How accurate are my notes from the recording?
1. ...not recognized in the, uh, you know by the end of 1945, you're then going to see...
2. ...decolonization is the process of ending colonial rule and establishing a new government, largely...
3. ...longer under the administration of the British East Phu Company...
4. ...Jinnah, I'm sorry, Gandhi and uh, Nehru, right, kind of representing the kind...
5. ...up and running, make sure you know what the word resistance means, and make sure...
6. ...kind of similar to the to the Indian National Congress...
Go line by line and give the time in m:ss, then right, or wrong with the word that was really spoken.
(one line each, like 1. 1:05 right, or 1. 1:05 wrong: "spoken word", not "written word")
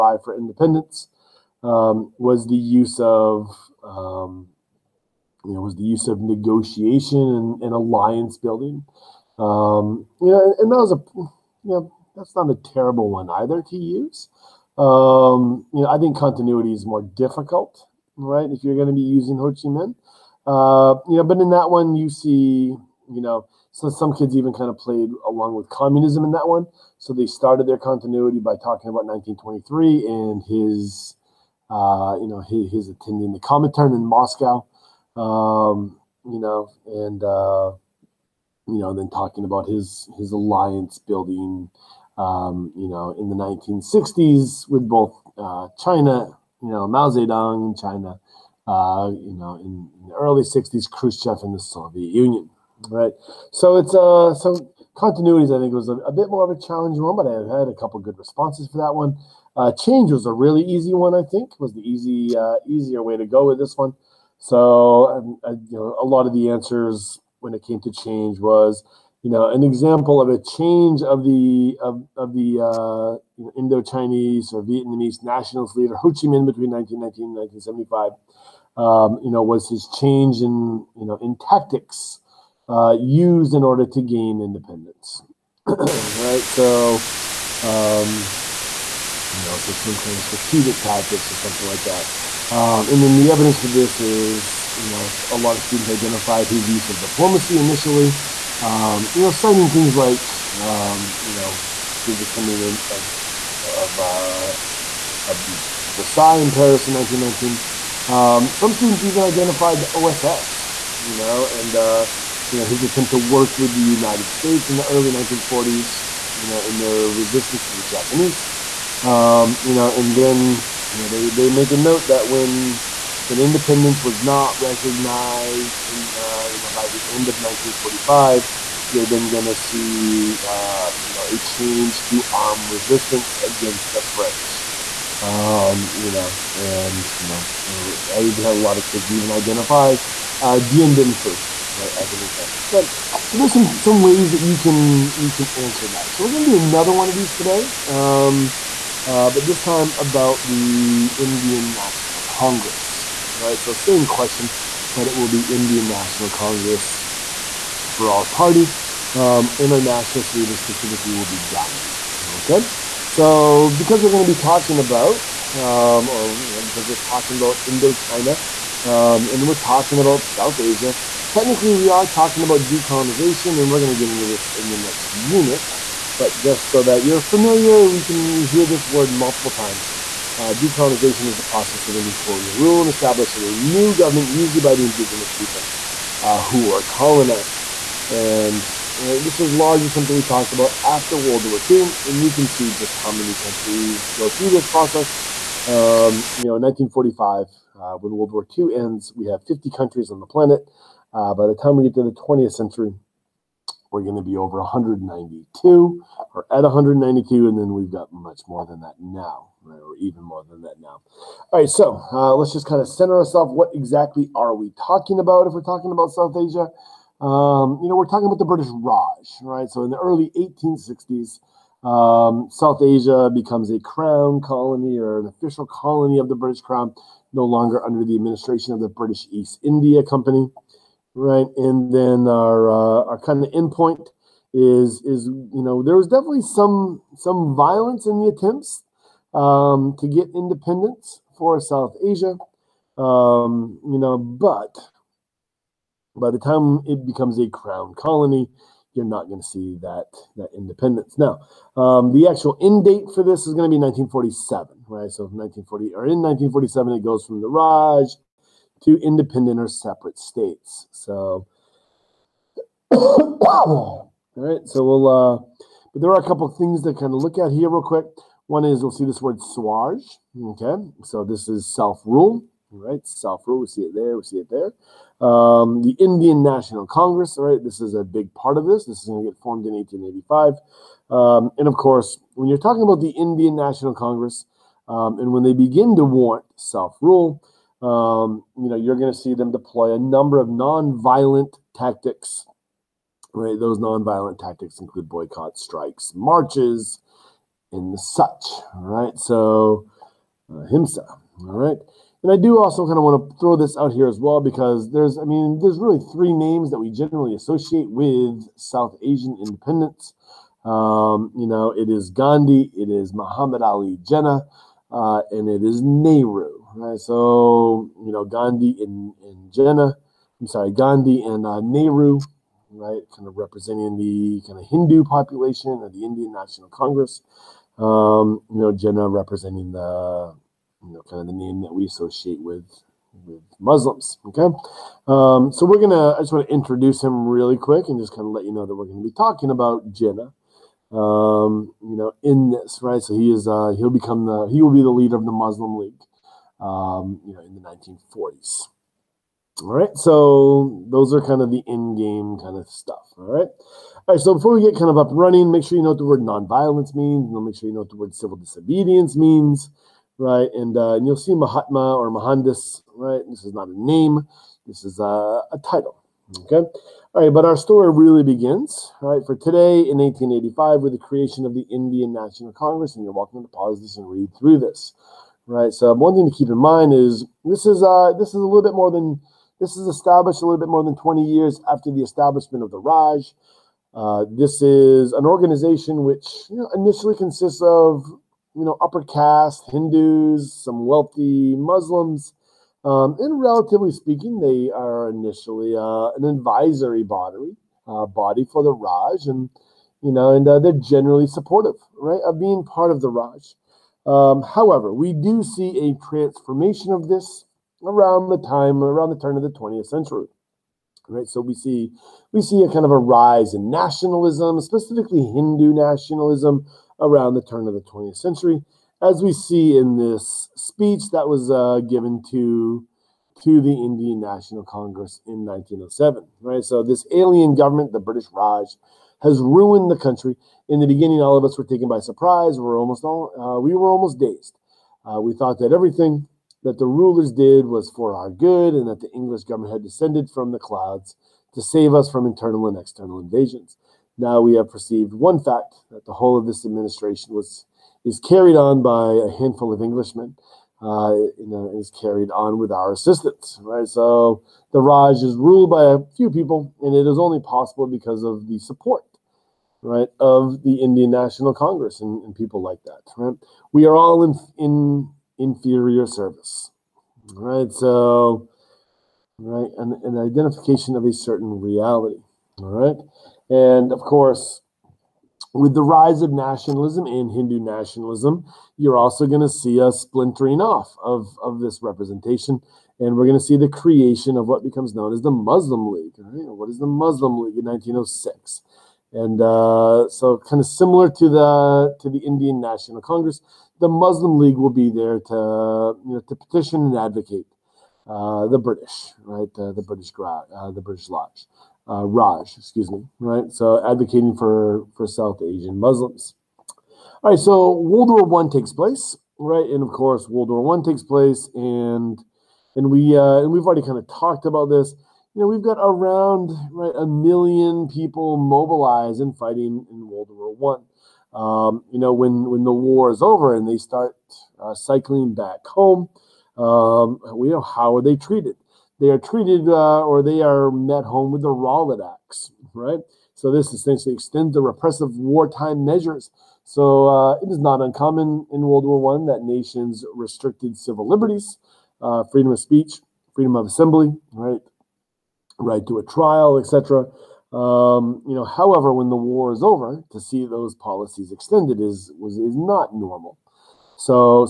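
1. 2:04 right
2. 3:00 wrong: "usually", not "largely"
3. 3:47 wrong: "India", not "Phu"
4. 5:19 right
5. 5:54 wrong: "nonviolence", not "resistance"
6. 8:10 right.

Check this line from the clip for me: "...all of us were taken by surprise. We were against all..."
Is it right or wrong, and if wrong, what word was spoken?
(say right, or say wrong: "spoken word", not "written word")
wrong: "almost", not "against".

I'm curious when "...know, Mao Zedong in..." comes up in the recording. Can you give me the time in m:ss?
0:46.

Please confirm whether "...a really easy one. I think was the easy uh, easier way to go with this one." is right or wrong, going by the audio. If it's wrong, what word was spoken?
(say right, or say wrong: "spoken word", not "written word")
right.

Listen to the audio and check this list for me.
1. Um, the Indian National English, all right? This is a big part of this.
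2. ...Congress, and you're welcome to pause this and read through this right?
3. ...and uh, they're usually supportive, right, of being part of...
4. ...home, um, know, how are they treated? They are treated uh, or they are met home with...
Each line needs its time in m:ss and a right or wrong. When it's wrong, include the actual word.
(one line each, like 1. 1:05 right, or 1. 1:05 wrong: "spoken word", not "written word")
1. 4:35 wrong: "Congress", not "English"
2. 6:12 right
3. 6:40 wrong: "generally", not "usually"
4. 8:45 right.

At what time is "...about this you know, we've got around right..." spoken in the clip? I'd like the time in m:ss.
8:34.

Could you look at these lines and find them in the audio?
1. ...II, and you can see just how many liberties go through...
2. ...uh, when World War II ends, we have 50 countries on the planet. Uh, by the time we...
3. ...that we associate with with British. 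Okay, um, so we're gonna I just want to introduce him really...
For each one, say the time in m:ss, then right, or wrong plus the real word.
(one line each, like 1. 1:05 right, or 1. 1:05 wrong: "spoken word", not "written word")
1. 3:11 wrong: "countries", not "liberties"
2. 3:17 right
3. 5:31 wrong: "Muslims", not "British".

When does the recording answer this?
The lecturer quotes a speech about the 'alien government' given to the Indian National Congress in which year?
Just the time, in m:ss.
7:05.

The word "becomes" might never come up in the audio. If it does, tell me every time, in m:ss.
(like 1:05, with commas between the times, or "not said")
3:43, 4:07, 5:43, 8:04.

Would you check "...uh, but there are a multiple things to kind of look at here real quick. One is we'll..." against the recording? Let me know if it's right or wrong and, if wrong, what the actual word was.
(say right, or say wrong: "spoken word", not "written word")
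wrong: "couple", not "multiple".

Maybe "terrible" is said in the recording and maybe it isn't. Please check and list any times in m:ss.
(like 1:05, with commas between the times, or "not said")
0:12.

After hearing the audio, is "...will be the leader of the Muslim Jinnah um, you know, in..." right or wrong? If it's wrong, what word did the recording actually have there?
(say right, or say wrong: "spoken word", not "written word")
wrong: "League", not "Jinnah".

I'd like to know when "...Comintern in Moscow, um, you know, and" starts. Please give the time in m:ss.
0:33.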